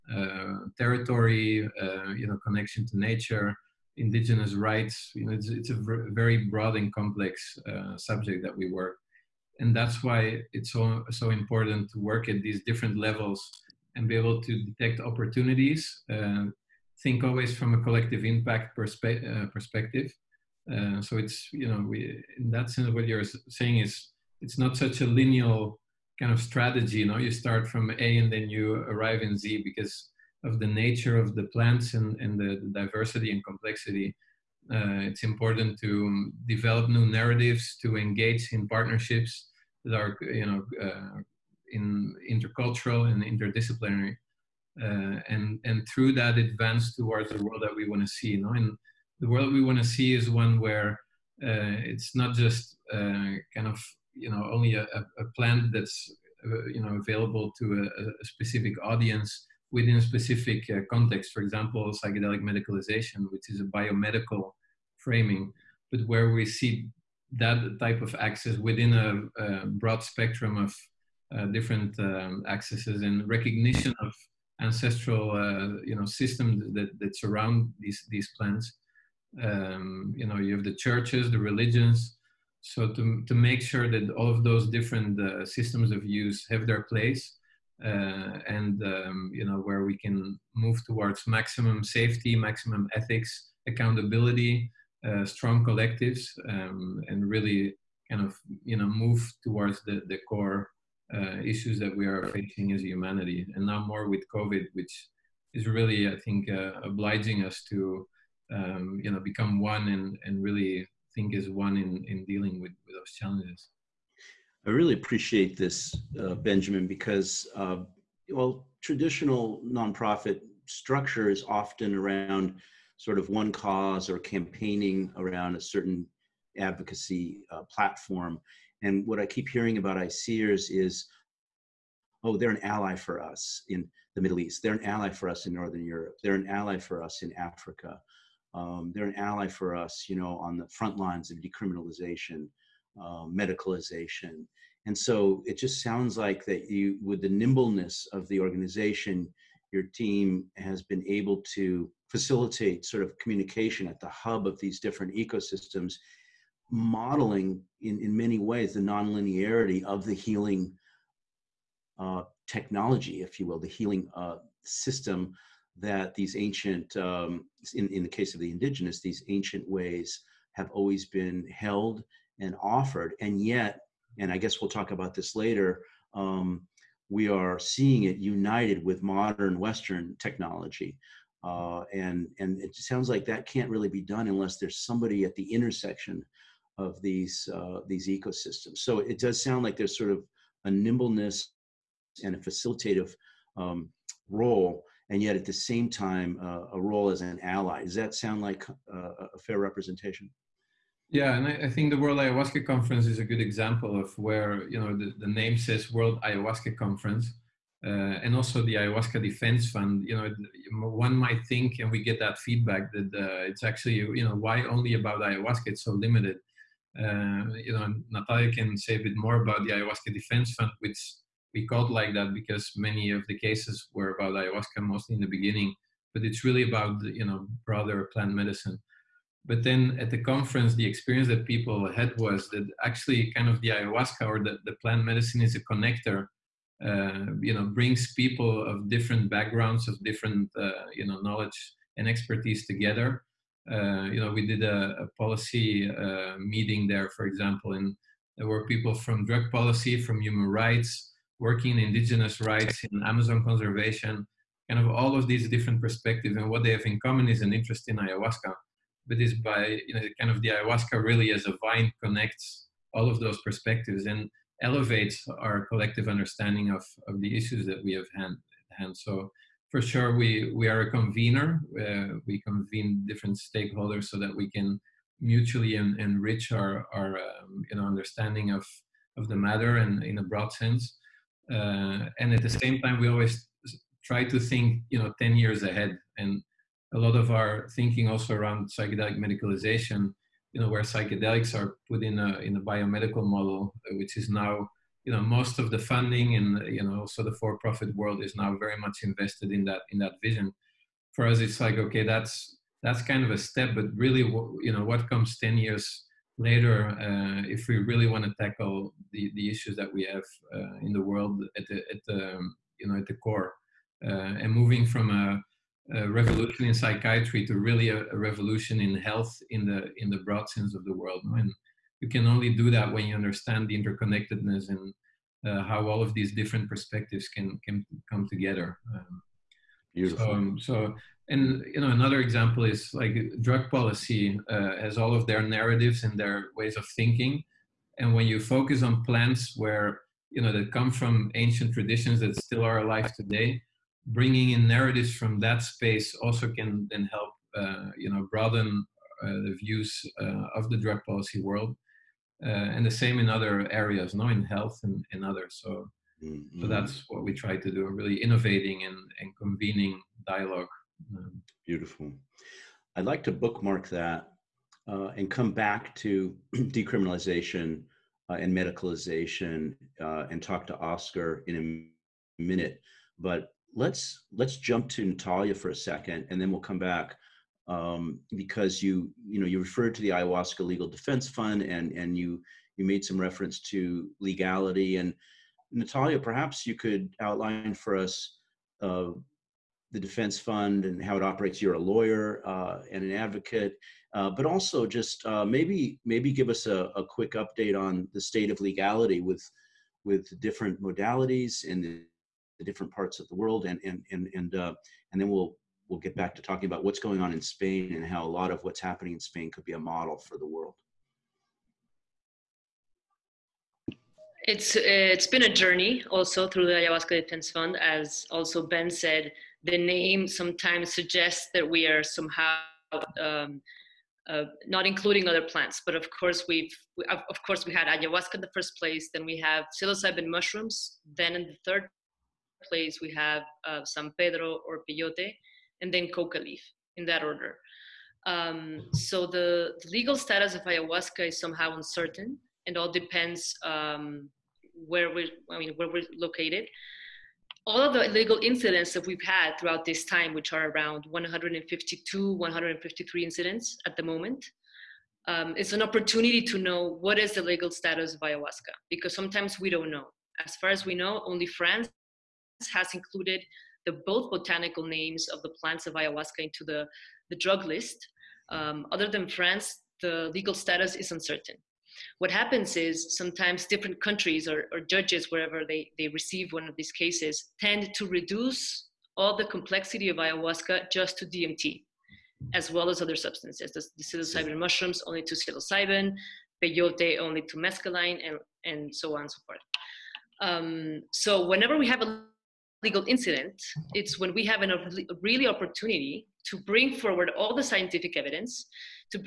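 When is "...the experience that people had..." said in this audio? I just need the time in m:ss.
3:50.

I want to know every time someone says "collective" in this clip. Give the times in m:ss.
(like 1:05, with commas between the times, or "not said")
0:17, 1:35, 4:25.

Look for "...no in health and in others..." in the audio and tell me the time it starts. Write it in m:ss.
5:54.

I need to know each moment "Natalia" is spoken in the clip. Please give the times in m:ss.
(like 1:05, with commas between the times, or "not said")
3:38, 6:15, 6:25.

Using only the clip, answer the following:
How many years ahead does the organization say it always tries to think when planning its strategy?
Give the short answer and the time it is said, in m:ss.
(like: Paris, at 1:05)
10, at 4:45.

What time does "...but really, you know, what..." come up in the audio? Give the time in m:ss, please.
5:03.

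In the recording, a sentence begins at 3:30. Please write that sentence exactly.
You know, one might think, and we get that feedback that uh, it's actually you know why only about ayahuasca?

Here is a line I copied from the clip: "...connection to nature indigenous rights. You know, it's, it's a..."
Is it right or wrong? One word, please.
right.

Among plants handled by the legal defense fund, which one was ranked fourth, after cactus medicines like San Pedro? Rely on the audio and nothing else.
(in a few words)
Coca leaf.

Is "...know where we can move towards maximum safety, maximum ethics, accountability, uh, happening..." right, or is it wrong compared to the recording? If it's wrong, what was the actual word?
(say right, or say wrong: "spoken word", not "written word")
wrong: "strong", not "happening".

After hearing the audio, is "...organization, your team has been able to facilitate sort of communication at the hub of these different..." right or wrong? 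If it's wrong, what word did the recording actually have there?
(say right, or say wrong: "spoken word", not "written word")
right.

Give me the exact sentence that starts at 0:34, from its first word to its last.
Uh, it's important to um, develop new narratives, to engage in partnerships that are, you know, uh, in intercultural and interdisciplinary.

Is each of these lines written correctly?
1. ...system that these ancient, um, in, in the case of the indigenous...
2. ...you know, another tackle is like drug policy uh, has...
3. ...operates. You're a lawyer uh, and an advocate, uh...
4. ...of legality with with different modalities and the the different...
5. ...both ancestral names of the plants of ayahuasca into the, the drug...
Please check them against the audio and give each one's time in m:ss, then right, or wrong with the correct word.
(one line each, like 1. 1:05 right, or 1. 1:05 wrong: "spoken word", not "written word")
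1. 2:44 right
2. 5:31 wrong: "example", not "tackle"
3. 6:31 right
4. 6:38 right
5. 7:44 wrong: "botanical", not "ancestral".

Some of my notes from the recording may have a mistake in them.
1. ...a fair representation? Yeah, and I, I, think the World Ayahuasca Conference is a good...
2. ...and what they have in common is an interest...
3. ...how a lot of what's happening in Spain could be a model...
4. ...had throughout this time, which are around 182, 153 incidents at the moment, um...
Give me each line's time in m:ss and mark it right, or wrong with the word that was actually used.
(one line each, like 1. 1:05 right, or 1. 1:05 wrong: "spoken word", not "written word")
1. 3:19 right
2. 4:16 right
3. 6:48 right
4. 7:29 wrong: "152", not "182".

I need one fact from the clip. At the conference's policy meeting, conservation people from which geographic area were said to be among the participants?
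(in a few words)
Amazon.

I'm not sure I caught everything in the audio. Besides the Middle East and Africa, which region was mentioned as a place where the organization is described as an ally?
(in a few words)
Northern Europe.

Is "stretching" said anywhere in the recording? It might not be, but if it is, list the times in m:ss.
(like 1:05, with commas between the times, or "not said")
not said.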